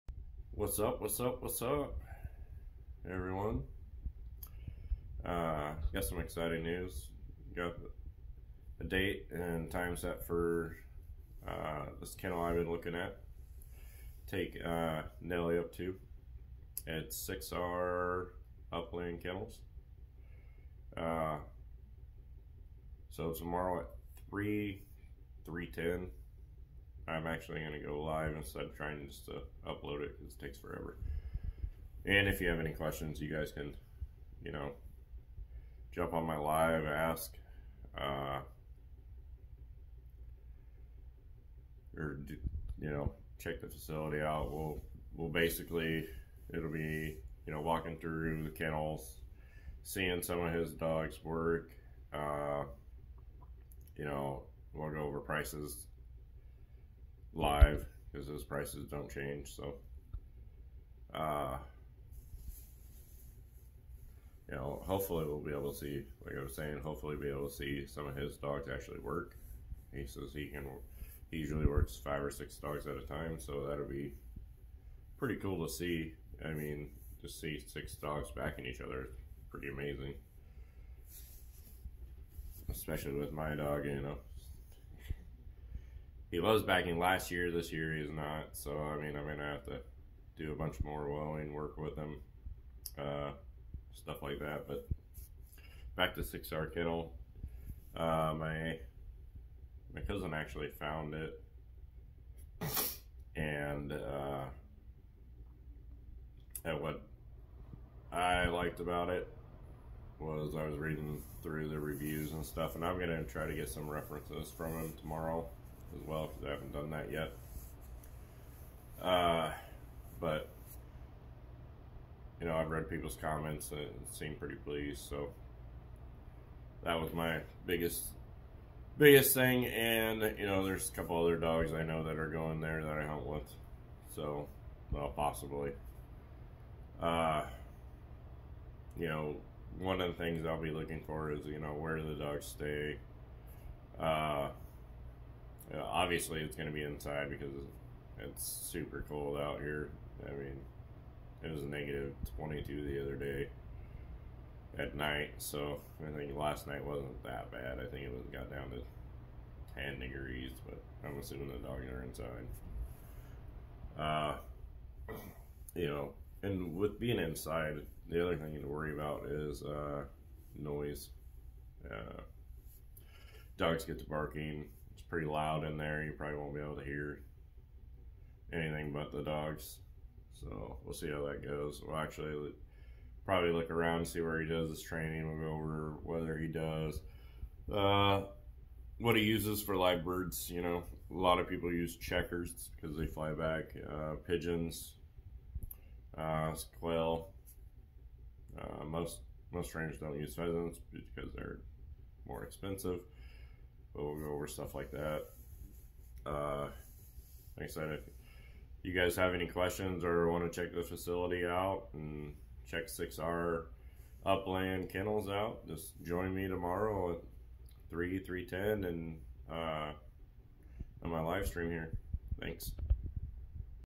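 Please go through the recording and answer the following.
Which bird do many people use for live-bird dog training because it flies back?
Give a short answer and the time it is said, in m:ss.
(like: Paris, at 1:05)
Chukars, at 3:11.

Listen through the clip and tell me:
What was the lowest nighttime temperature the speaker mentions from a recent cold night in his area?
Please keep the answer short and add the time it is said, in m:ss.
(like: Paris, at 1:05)
-22, at 2:31.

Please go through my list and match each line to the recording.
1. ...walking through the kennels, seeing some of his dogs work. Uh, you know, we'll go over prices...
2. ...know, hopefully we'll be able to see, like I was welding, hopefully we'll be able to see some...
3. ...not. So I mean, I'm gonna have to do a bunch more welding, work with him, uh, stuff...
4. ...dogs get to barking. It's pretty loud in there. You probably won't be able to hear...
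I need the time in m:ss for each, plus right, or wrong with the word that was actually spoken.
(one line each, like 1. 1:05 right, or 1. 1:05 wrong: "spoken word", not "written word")
1. 0:47 right
2. 1:04 wrong: "saying", not "welding"
3. 1:28 right
4. 2:53 right.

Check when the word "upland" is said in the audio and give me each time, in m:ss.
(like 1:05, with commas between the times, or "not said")
0:18, 3:34.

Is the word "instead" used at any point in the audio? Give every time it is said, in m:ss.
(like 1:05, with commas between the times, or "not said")
0:28.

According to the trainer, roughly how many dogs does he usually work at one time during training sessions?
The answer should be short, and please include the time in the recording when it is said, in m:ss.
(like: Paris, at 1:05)
5 or 6, at 1:11.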